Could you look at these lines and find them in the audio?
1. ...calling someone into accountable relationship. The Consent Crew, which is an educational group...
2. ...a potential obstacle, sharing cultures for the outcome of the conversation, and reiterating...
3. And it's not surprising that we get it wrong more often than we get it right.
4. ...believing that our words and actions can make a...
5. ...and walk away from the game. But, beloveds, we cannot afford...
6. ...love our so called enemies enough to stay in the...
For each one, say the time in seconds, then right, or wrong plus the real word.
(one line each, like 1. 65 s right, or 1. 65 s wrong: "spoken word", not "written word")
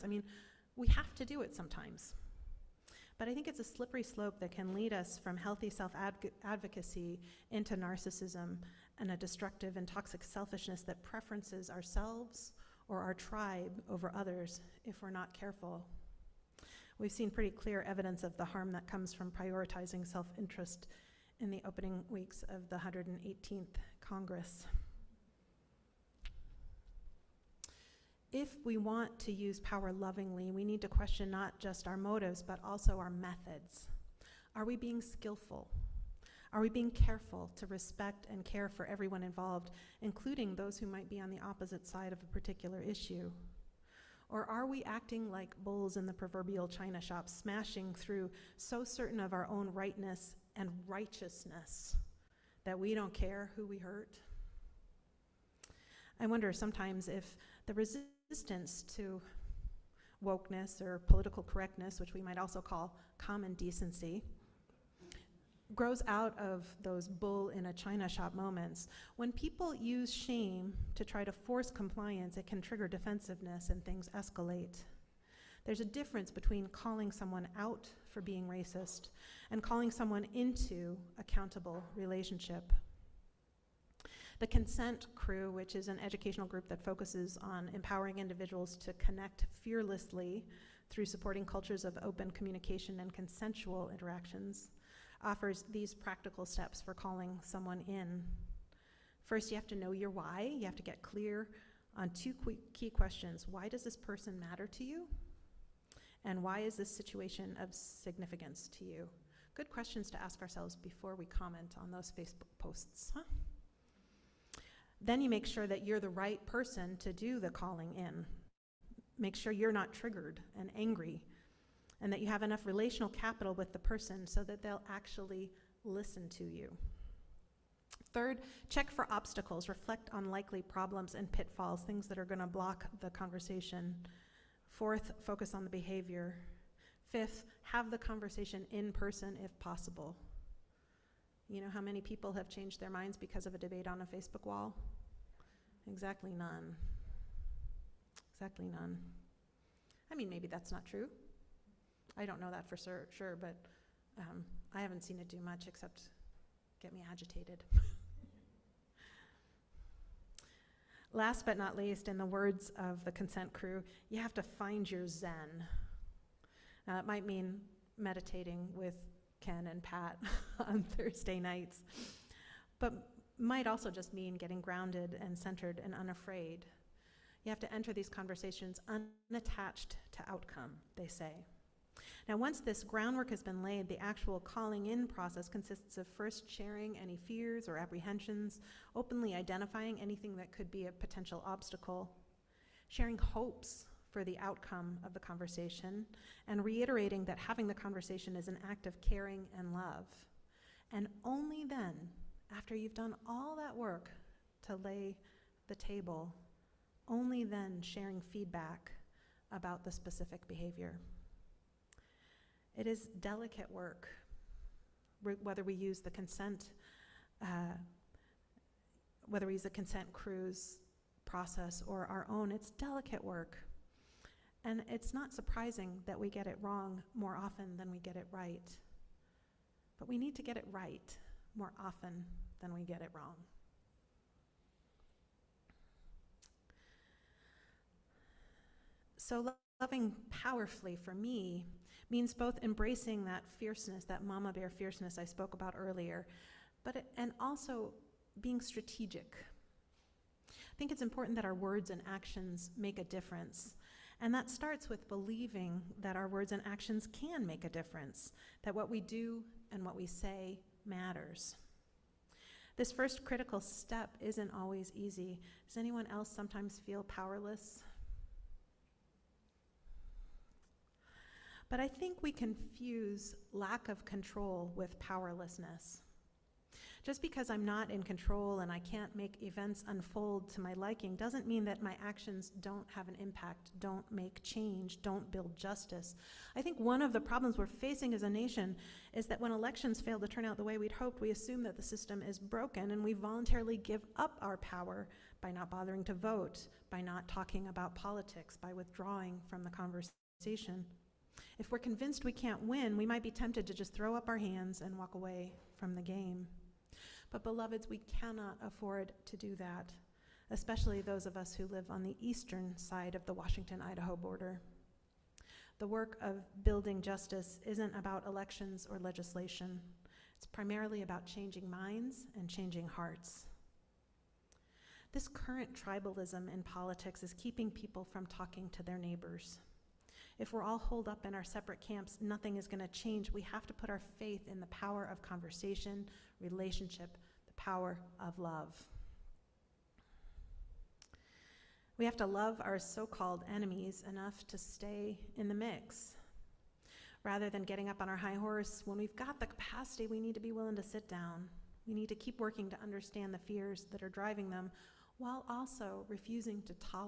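1. 79 s right
2. 190 s wrong: "hopes", not "cultures"
3. 224 s right
4. 255 s right
5. 304 s right
6. 342 s right.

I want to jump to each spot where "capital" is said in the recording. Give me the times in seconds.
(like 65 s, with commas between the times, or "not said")
123 s.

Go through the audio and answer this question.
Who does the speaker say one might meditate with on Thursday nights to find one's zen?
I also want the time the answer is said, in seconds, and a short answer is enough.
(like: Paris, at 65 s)
Ken and Pat, at 169 s.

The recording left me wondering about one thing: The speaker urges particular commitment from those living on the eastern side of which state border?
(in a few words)
Washington Idaho border.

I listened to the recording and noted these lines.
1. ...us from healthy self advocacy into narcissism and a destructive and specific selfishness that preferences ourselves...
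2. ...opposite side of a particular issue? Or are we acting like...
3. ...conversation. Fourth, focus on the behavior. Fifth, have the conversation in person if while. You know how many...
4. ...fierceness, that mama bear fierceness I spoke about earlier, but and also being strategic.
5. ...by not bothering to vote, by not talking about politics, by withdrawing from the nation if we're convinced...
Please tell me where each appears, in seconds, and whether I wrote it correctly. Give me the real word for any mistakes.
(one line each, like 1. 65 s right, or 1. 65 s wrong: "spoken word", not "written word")
1. 4 s wrong: "toxic", not "specific"
2. 41 s right
3. 133 s wrong: "possible", not "while"
4. 243 s right
5. 295 s wrong: "conversation", not "nation".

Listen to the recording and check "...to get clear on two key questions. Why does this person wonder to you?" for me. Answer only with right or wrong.
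wrong.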